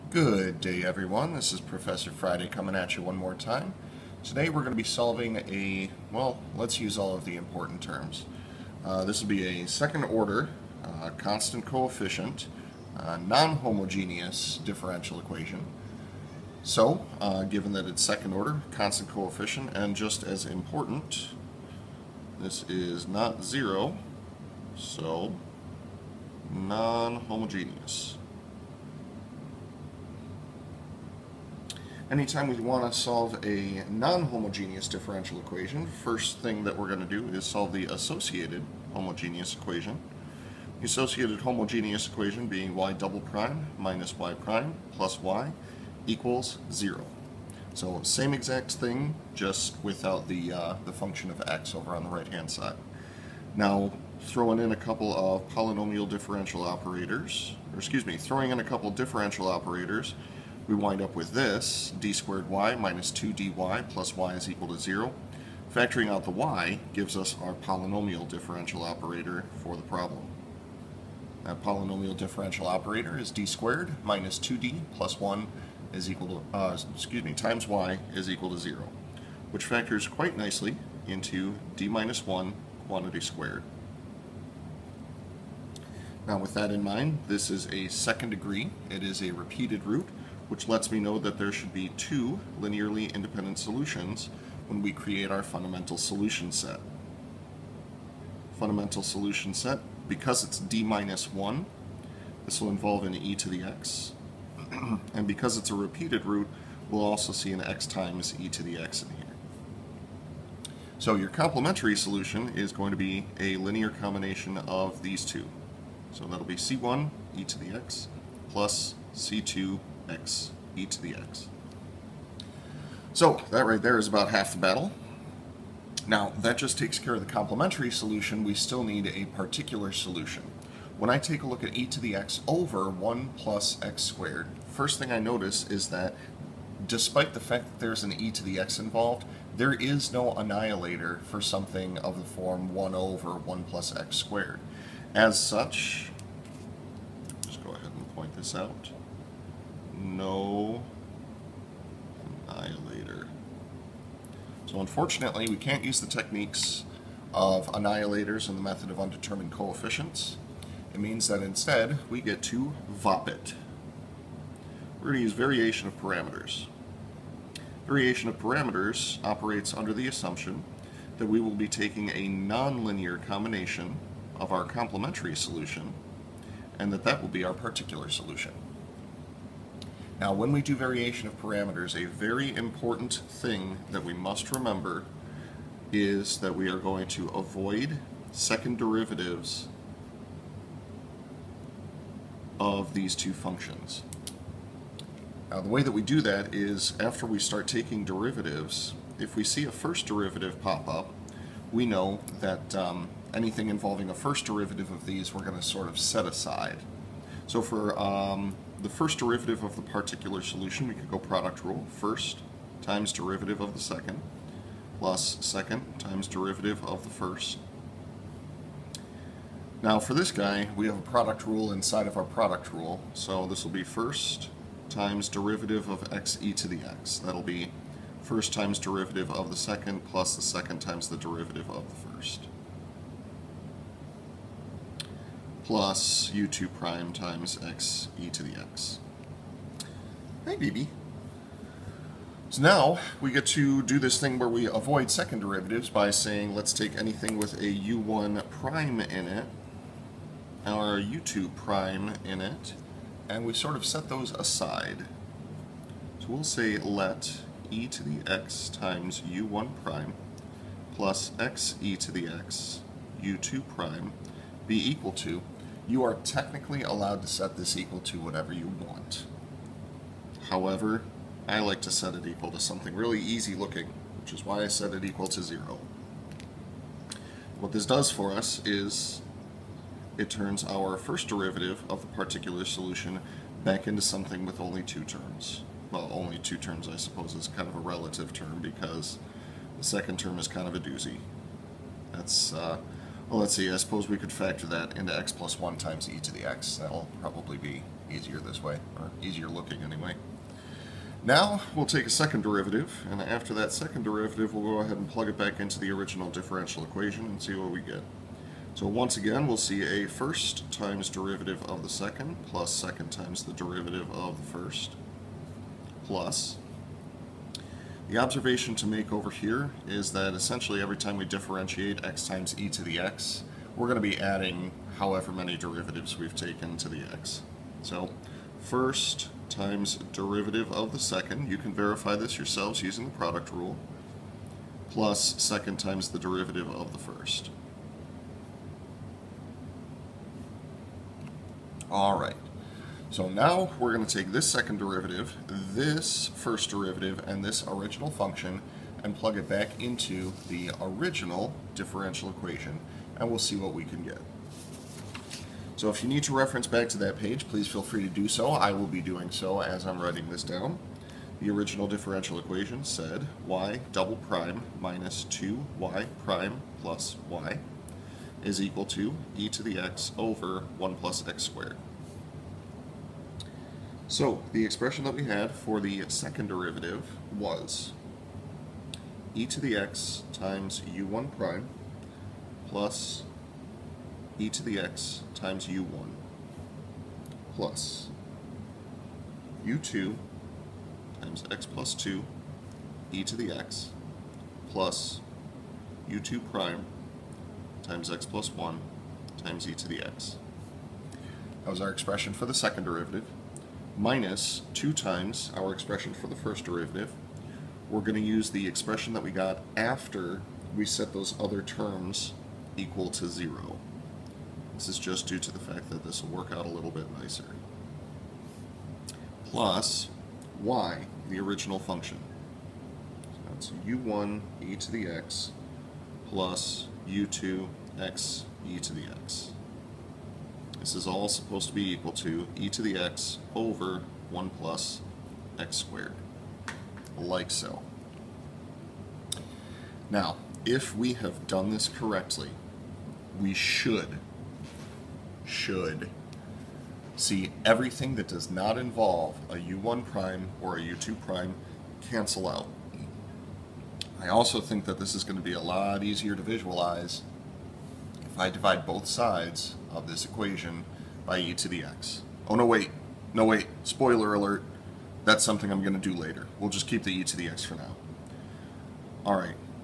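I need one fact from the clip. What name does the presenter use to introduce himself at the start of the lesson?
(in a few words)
Professor Friday.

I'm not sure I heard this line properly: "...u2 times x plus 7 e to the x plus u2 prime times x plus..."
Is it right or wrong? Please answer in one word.
wrong.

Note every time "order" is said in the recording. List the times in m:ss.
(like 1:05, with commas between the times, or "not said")
0:10, 0:18.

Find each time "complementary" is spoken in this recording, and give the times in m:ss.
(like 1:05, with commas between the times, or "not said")
1:51, 2:07, 2:54.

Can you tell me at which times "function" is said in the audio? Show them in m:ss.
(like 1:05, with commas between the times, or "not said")
0:50, 3:13, 5:48, 7:01.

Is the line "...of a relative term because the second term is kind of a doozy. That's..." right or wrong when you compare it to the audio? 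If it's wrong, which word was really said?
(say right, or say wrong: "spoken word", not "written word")
right.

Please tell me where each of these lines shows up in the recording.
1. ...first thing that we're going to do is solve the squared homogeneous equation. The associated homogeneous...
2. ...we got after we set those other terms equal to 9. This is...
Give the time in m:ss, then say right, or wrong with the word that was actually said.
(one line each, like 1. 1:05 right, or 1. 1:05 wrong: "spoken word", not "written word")
1. 0:35 wrong: "associated", not "squared"
2. 6:49 wrong: "0", not "9".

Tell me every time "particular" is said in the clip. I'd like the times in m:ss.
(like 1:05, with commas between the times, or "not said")
2:09, 2:57, 3:29, 4:42.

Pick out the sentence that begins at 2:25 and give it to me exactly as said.
As such, just go ahead and point this out no annihilator.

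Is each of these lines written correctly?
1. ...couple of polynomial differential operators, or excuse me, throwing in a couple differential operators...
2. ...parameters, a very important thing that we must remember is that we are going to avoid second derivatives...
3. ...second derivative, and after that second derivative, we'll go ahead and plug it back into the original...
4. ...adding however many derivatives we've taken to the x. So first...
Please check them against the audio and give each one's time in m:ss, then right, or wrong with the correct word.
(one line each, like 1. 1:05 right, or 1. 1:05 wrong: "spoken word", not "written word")
1. 0:54 right
2. 3:01 right
3. 5:02 right
4. 5:24 right.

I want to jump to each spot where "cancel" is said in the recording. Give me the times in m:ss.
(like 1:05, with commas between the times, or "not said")
7:32.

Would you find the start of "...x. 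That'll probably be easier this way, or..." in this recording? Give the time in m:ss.
4:56.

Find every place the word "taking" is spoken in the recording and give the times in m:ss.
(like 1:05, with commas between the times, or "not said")
2:51, 3:17.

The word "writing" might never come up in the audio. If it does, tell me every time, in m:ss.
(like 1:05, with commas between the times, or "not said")
6:00.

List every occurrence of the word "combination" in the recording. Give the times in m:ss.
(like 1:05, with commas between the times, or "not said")
1:53, 2:53.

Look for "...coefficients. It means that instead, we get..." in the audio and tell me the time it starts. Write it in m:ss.
2:39.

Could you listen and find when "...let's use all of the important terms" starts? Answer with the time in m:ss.
0:06.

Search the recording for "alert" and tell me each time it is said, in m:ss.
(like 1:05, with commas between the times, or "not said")
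7:44.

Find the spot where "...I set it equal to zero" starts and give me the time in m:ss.
4:34.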